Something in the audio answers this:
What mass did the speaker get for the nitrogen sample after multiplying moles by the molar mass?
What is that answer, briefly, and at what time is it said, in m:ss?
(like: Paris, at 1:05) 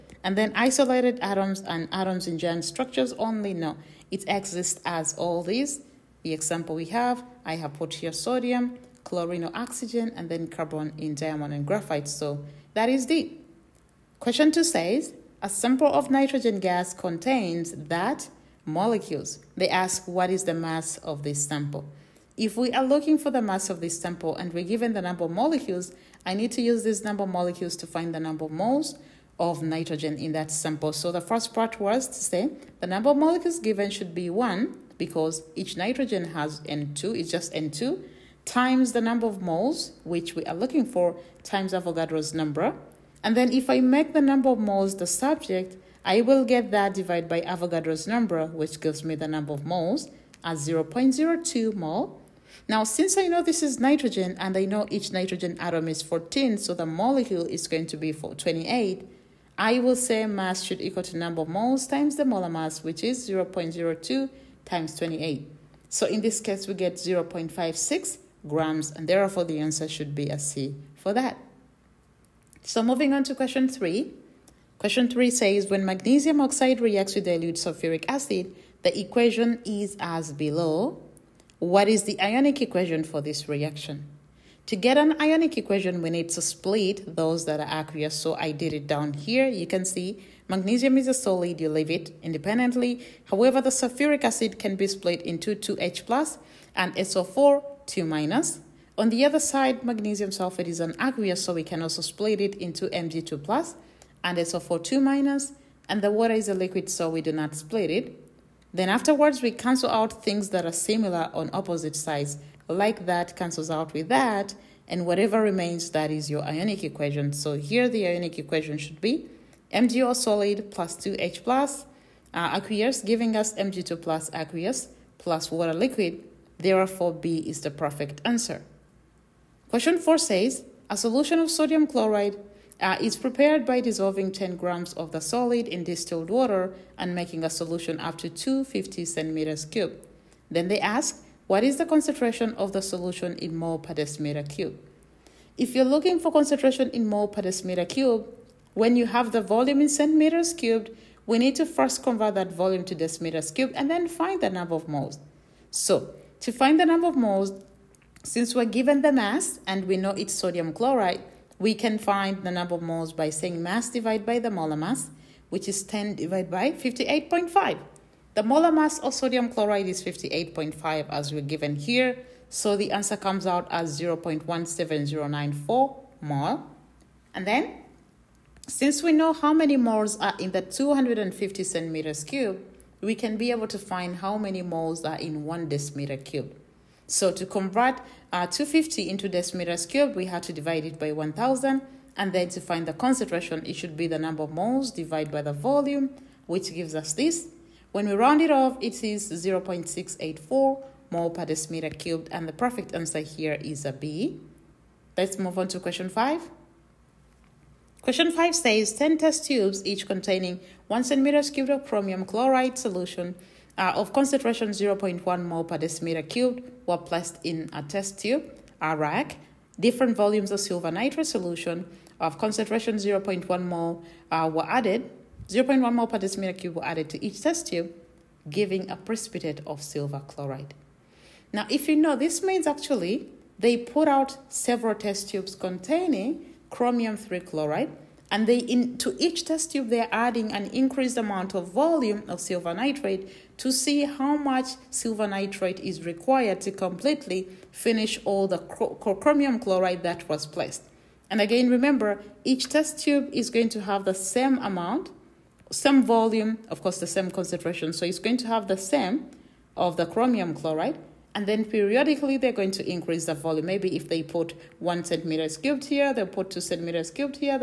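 0.56 grams, at 1:06.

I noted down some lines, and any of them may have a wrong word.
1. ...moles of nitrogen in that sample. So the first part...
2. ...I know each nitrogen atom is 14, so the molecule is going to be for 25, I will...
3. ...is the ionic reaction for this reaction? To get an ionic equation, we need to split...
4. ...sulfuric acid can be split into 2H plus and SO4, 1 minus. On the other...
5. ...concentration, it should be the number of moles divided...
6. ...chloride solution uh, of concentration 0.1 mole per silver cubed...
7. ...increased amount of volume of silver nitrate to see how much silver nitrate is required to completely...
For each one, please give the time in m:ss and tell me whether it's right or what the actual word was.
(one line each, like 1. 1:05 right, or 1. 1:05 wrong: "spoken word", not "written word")
1. 0:28 right
2. 0:54 wrong: "28", not "25"
3. 1:21 wrong: "equation", not "reaction"
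4. 1:33 wrong: "2", not "1"
5. 3:12 right
6. 3:32 wrong: "decimeter", not "silver"
7. 4:00 right.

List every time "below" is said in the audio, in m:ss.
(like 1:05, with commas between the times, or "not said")
1:20.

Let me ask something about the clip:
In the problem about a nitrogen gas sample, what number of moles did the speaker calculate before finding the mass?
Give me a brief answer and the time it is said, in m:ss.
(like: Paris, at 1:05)
0.02 mole, at 0:50.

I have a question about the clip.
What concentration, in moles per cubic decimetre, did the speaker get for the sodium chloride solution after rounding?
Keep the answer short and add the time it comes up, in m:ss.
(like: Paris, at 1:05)
0.684, at 3:19.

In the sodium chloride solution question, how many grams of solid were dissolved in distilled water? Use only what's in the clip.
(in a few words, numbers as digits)
10 grams.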